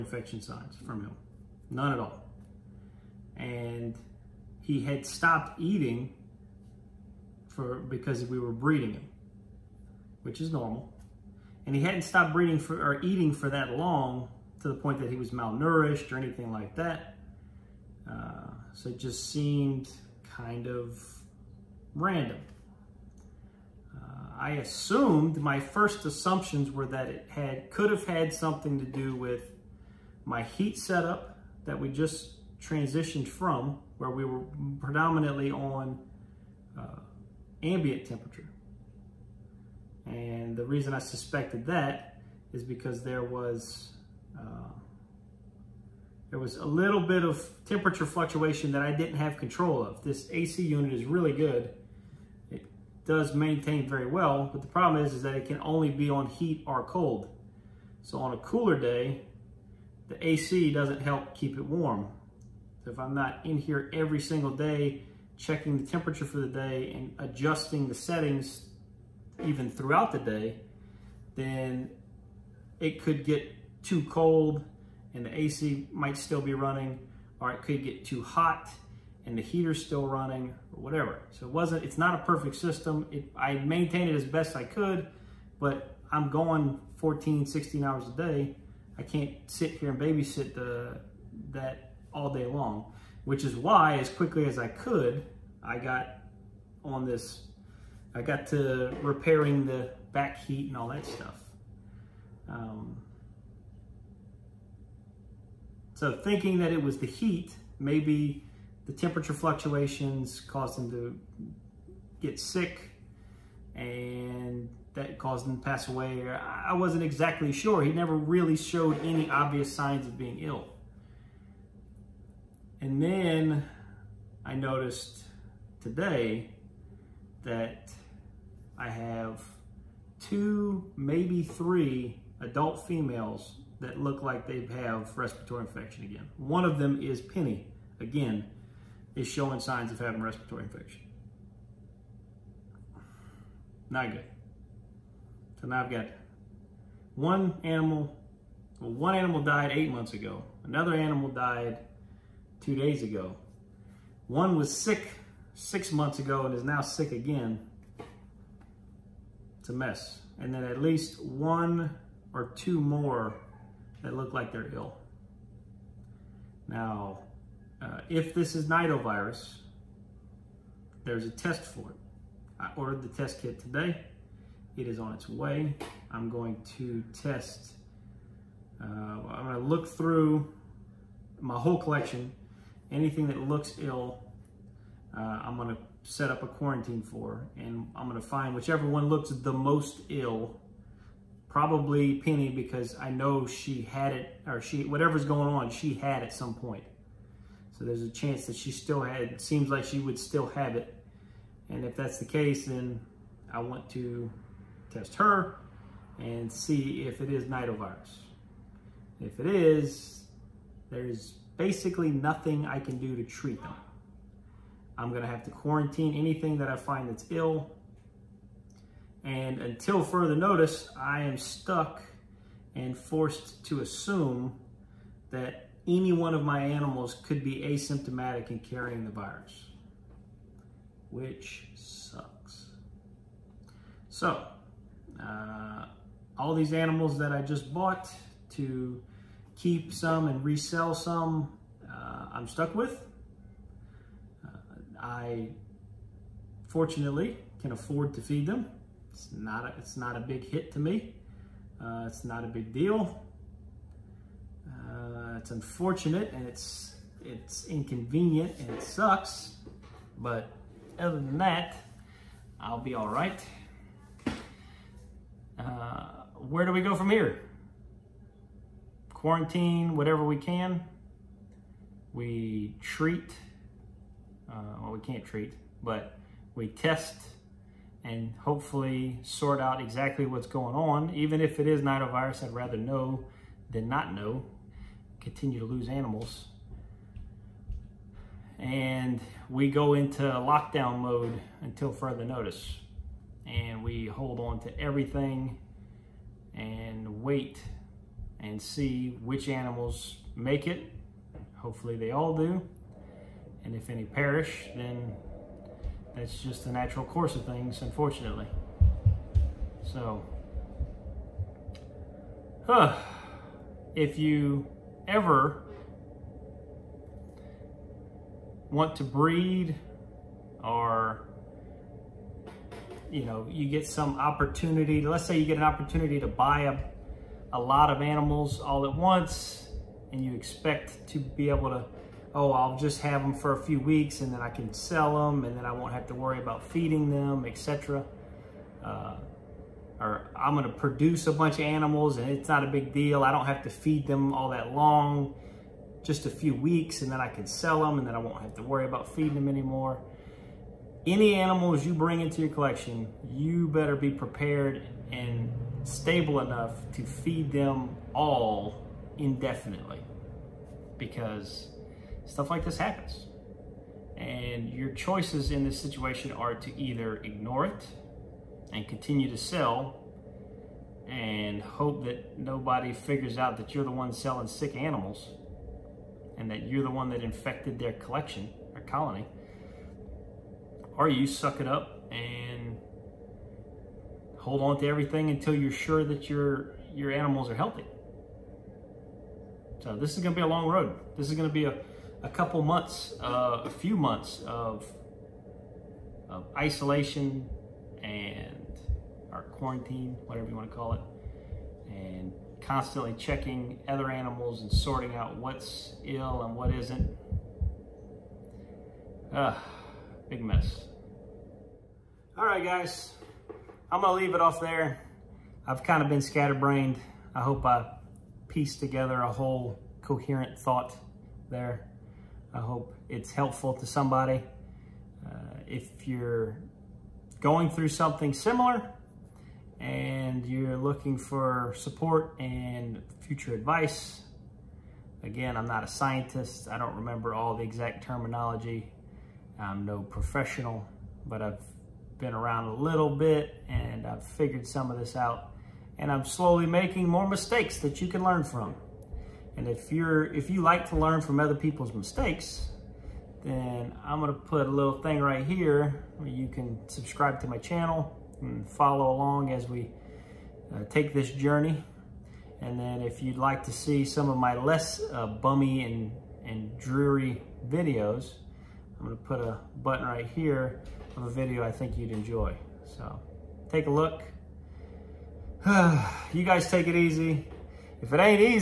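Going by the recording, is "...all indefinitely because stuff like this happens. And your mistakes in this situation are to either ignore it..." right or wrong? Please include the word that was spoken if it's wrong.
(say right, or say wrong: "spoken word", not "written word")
wrong: "choices", not "mistakes".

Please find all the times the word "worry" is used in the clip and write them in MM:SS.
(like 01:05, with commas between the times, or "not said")
05:36, 05:48.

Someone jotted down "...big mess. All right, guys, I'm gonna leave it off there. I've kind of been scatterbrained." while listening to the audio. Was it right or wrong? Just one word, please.
right.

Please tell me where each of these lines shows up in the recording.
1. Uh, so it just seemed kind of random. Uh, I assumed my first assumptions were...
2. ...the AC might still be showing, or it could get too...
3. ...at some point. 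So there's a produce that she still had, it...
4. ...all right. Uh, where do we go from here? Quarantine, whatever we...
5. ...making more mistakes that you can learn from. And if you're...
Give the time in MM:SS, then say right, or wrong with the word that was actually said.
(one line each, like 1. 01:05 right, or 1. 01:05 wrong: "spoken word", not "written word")
1. 00:18 right
2. 01:15 wrong: "running", not "showing"
3. 03:16 wrong: "chance", not "produce"
4. 04:22 right
5. 07:26 right.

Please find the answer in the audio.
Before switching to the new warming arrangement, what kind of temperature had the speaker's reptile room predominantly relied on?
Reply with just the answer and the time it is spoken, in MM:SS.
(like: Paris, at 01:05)
ambient temperature, at 00:37.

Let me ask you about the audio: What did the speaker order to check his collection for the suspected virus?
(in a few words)
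test kit.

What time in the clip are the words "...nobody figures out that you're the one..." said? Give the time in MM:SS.
06:12.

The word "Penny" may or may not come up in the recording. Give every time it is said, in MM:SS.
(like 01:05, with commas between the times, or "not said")
02:17, 03:12.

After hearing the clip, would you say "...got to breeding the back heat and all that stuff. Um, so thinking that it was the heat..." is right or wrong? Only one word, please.
wrong.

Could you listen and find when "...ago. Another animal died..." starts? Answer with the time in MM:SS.
02:30.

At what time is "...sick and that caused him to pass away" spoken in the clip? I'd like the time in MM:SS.
01:52.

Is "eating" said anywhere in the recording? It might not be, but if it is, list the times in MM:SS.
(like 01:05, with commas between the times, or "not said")
00:05, 00:13.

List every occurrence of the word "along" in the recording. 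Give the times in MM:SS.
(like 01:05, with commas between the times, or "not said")
07:39.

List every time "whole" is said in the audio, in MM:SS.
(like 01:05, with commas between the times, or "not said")
03:01, 06:59.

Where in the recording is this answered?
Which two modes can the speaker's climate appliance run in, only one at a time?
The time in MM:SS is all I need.
00:56.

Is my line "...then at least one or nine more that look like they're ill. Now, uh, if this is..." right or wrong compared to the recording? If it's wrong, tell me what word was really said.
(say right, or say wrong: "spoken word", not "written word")
wrong: "two", not "nine".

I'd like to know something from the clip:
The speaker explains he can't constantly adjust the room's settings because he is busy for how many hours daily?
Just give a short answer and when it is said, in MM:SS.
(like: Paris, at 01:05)
14, 16 hours, at 01:26.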